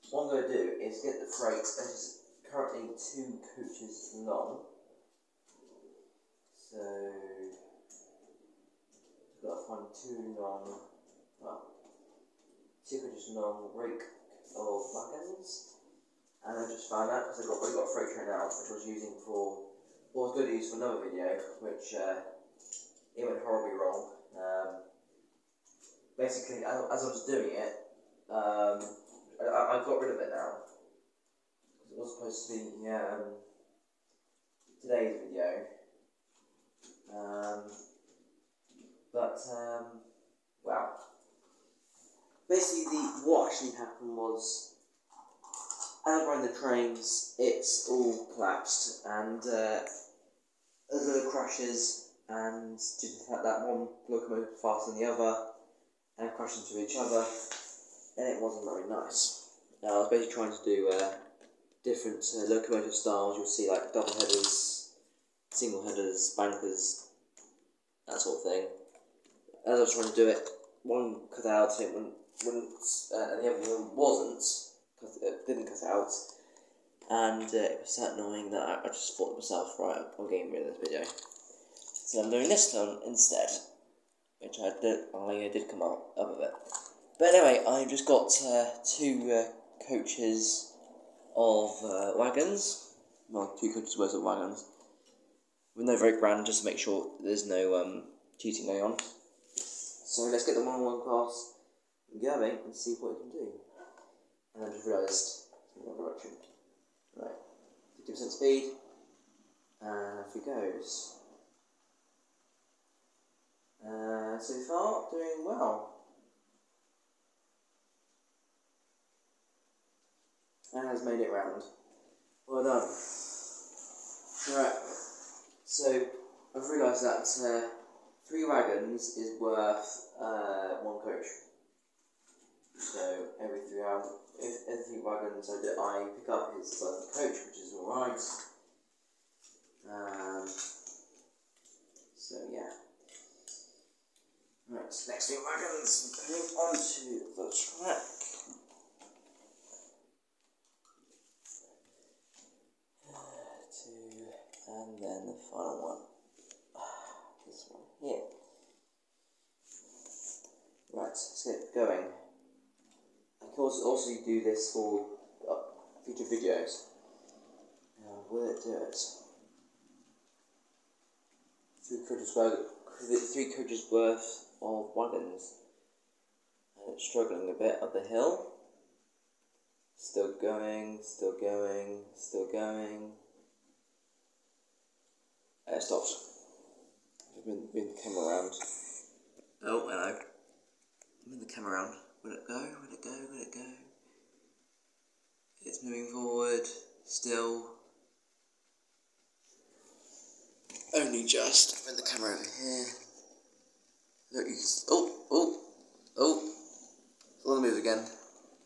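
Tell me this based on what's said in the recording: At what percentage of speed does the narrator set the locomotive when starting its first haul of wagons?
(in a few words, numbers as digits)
50%.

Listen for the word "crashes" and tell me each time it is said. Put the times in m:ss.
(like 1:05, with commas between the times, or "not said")
0:51, 0:56.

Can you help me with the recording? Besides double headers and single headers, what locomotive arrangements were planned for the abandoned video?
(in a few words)
bankers.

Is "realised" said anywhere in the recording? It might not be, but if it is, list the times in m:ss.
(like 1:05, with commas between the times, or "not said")
1:44, 2:06.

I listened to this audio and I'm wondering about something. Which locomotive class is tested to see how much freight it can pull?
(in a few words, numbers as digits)
one-on-one class.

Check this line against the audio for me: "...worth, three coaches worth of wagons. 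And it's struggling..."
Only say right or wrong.
right.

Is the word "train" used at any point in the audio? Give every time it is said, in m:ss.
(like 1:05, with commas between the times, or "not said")
0:18, 0:46.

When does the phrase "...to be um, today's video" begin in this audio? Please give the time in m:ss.
0:32.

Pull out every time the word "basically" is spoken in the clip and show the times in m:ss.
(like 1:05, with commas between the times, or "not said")
0:26, 0:42, 1:00.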